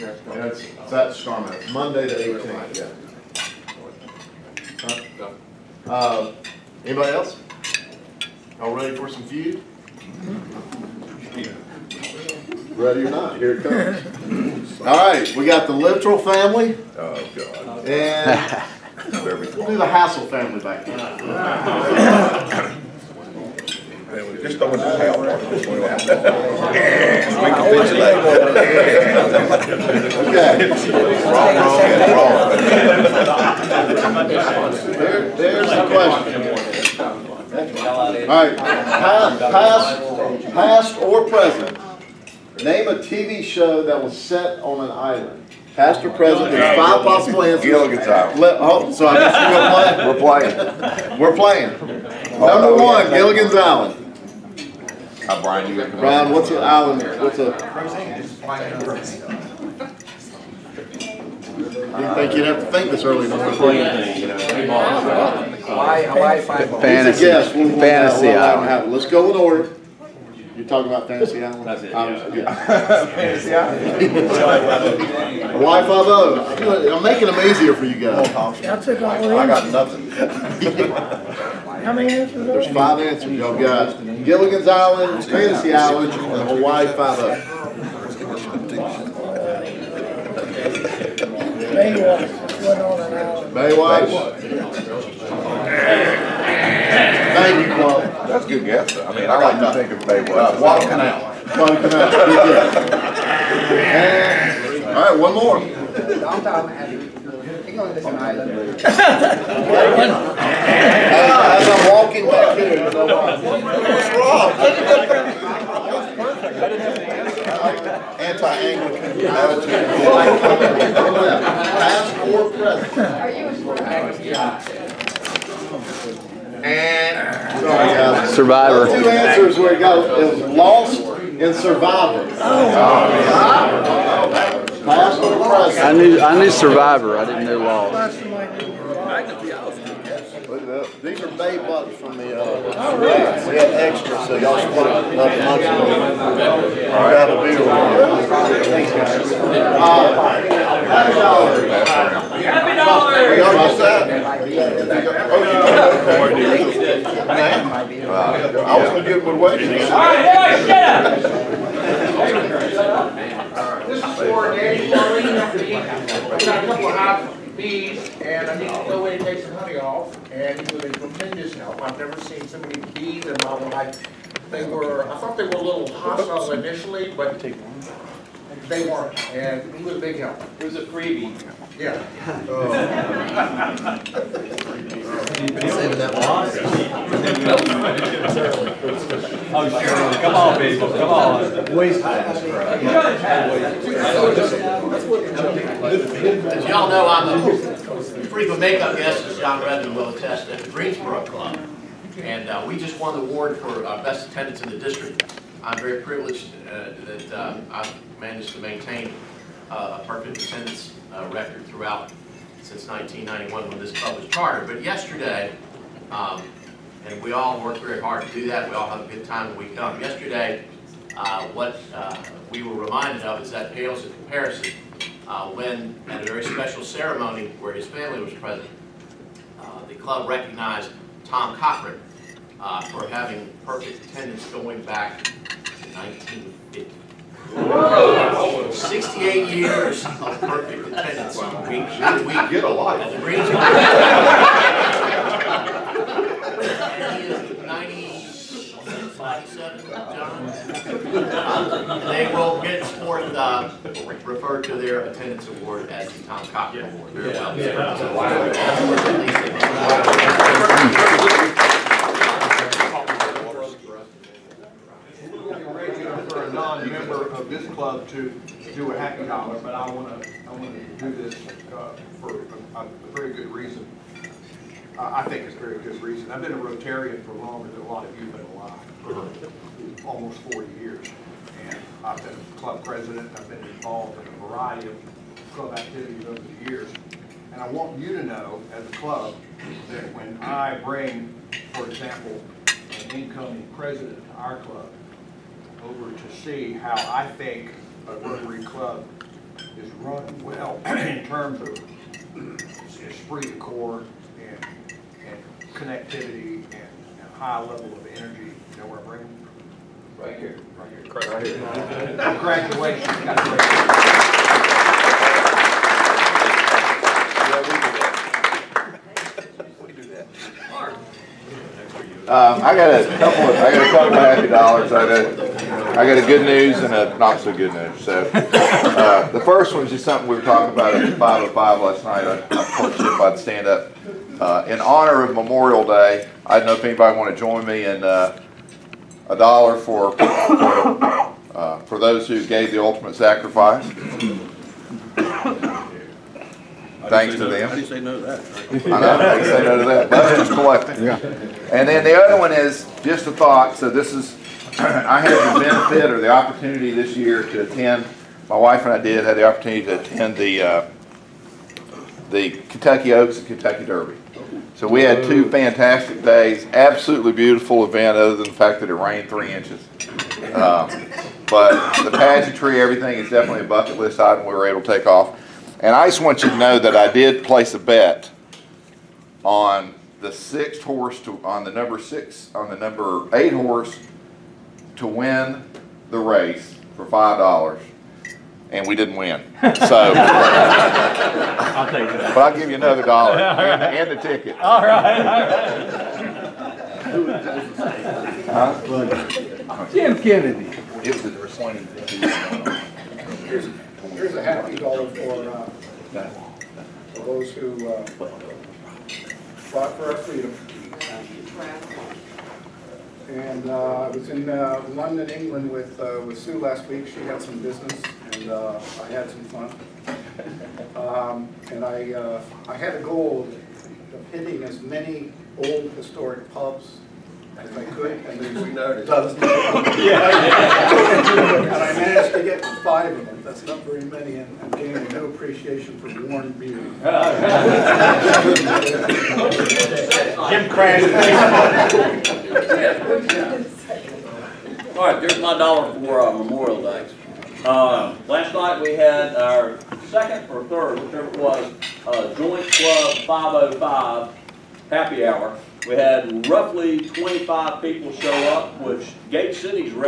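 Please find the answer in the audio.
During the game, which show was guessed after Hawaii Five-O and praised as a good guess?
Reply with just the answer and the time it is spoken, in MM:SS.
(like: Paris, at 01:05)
Baywatch, at 01:33.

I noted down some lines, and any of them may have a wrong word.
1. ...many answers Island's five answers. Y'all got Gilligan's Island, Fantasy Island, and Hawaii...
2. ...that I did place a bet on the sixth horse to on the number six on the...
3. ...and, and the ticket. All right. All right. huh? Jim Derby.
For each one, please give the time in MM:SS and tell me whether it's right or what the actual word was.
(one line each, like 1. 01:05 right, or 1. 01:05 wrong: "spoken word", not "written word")
1. 01:21 wrong: "There", not "Island"
2. 06:16 right
3. 06:33 wrong: "Kennedy", not "Derby".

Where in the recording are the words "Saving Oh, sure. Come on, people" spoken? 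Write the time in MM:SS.
03:05.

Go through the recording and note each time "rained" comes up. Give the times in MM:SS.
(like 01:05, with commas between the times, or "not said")
06:08.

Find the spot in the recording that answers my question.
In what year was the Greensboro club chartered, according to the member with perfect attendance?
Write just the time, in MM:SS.
03:32.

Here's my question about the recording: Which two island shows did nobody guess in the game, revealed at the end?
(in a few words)
Lost and Survivor.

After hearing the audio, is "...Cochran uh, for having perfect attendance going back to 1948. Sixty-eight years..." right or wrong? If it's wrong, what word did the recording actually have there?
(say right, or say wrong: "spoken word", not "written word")
wrong: "1950", not "1948".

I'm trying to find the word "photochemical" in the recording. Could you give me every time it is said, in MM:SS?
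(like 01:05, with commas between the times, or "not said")
not said.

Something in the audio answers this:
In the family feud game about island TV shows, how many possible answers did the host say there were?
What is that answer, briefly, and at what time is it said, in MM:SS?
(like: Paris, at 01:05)
5, at 00:46.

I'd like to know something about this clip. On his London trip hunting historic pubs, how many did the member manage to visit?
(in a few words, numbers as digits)
5.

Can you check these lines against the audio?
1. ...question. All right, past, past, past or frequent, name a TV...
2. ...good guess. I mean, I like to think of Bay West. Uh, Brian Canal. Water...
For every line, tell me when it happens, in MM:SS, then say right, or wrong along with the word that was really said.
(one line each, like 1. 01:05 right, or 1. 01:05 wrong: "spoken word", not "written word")
1. 00:35 wrong: "present", not "frequent"
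2. 01:38 wrong: "Water", not "Brian".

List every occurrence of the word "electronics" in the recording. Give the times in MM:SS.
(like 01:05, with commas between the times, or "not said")
not said.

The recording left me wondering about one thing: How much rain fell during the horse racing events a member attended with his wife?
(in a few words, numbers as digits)
3 inches.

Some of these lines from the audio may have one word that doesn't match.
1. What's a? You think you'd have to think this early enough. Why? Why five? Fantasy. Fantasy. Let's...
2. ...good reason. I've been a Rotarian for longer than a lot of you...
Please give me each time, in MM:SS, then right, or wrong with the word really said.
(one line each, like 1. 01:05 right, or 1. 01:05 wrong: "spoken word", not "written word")
1. 00:57 right
2. 04:35 right.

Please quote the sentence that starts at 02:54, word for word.
They were, I thought they were a little hostile initially, but they weren't, and he was a big help.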